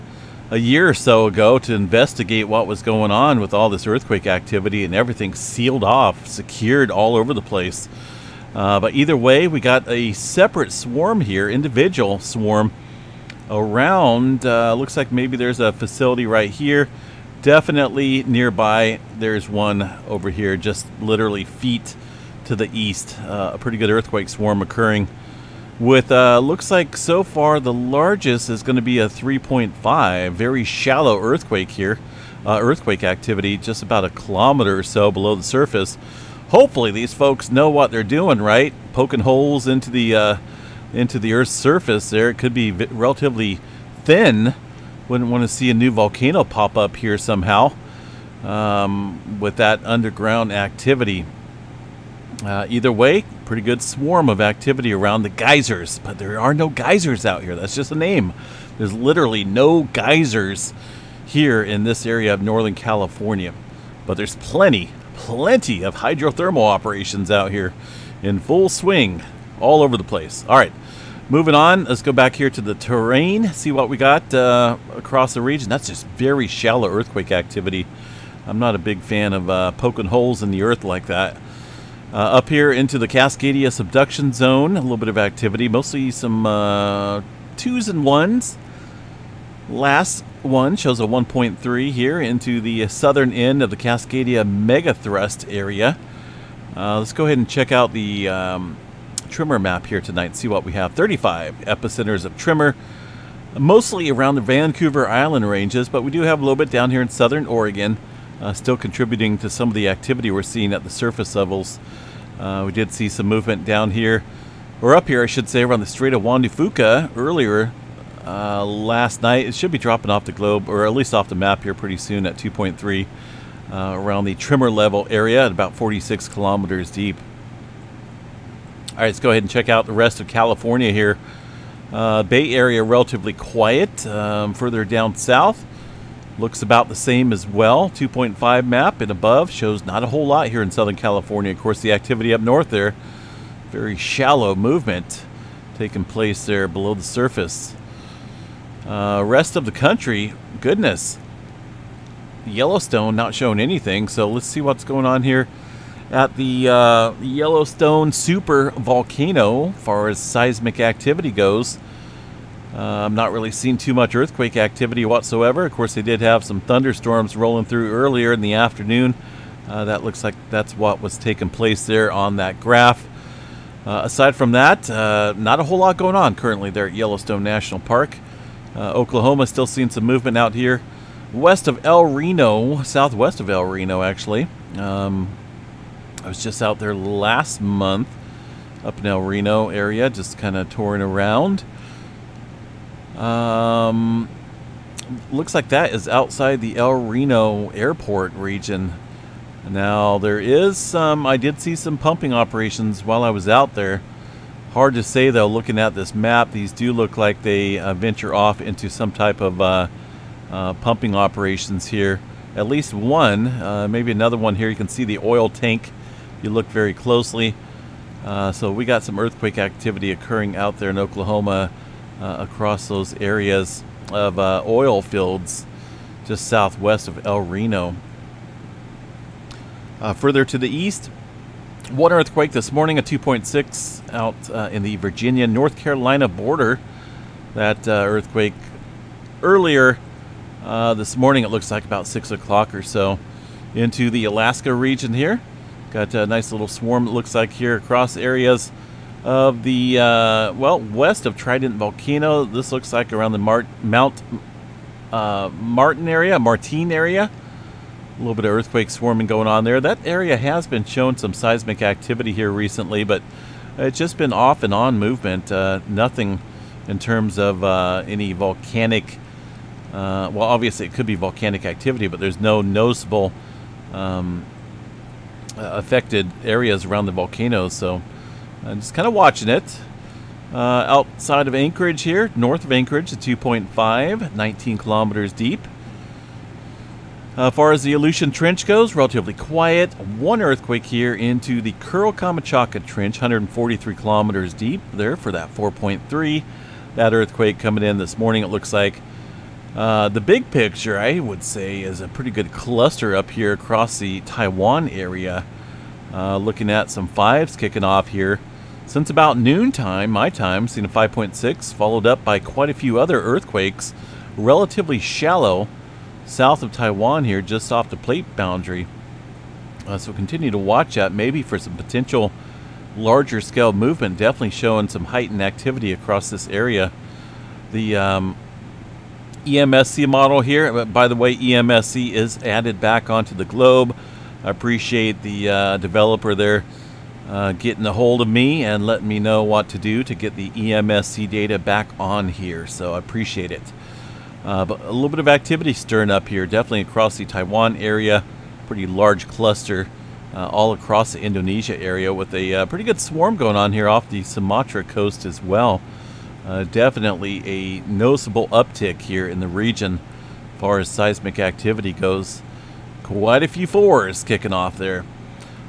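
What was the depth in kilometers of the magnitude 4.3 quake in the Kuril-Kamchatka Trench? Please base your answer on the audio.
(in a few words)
143.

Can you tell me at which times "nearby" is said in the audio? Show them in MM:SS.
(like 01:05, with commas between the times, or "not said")
00:18.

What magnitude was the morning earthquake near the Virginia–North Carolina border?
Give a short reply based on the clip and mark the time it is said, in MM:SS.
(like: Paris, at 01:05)
2.6, at 03:53.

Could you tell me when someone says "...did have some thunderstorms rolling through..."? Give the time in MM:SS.
02:46.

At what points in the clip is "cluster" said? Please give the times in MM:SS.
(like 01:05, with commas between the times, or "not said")
05:02, 05:49.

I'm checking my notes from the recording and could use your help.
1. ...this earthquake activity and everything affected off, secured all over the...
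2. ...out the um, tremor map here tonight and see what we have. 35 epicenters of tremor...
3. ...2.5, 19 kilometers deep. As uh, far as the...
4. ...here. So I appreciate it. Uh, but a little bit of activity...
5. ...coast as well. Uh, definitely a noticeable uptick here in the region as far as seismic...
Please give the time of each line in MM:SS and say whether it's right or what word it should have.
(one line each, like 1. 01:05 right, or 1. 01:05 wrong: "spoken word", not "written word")
1. 00:03 wrong: "sealed", not "affected"
2. 01:37 right
3. 04:43 right
4. 05:42 right
5. 05:54 right.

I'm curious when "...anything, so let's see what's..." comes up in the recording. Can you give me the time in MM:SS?
02:33.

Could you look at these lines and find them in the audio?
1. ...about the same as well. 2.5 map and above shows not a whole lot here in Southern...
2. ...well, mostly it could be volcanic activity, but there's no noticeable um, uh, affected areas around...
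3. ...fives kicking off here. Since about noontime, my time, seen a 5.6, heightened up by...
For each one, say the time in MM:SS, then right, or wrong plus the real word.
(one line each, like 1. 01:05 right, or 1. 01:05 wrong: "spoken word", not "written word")
1. 02:16 right
2. 04:30 wrong: "obviously", not "mostly"
3. 05:07 wrong: "followed", not "heightened".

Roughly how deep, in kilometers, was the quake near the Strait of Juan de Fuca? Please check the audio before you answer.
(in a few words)
46.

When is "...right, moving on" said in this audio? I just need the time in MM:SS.
01:10.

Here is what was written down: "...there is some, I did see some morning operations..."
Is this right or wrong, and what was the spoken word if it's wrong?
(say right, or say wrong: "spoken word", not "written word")
wrong: "pumping", not "morning".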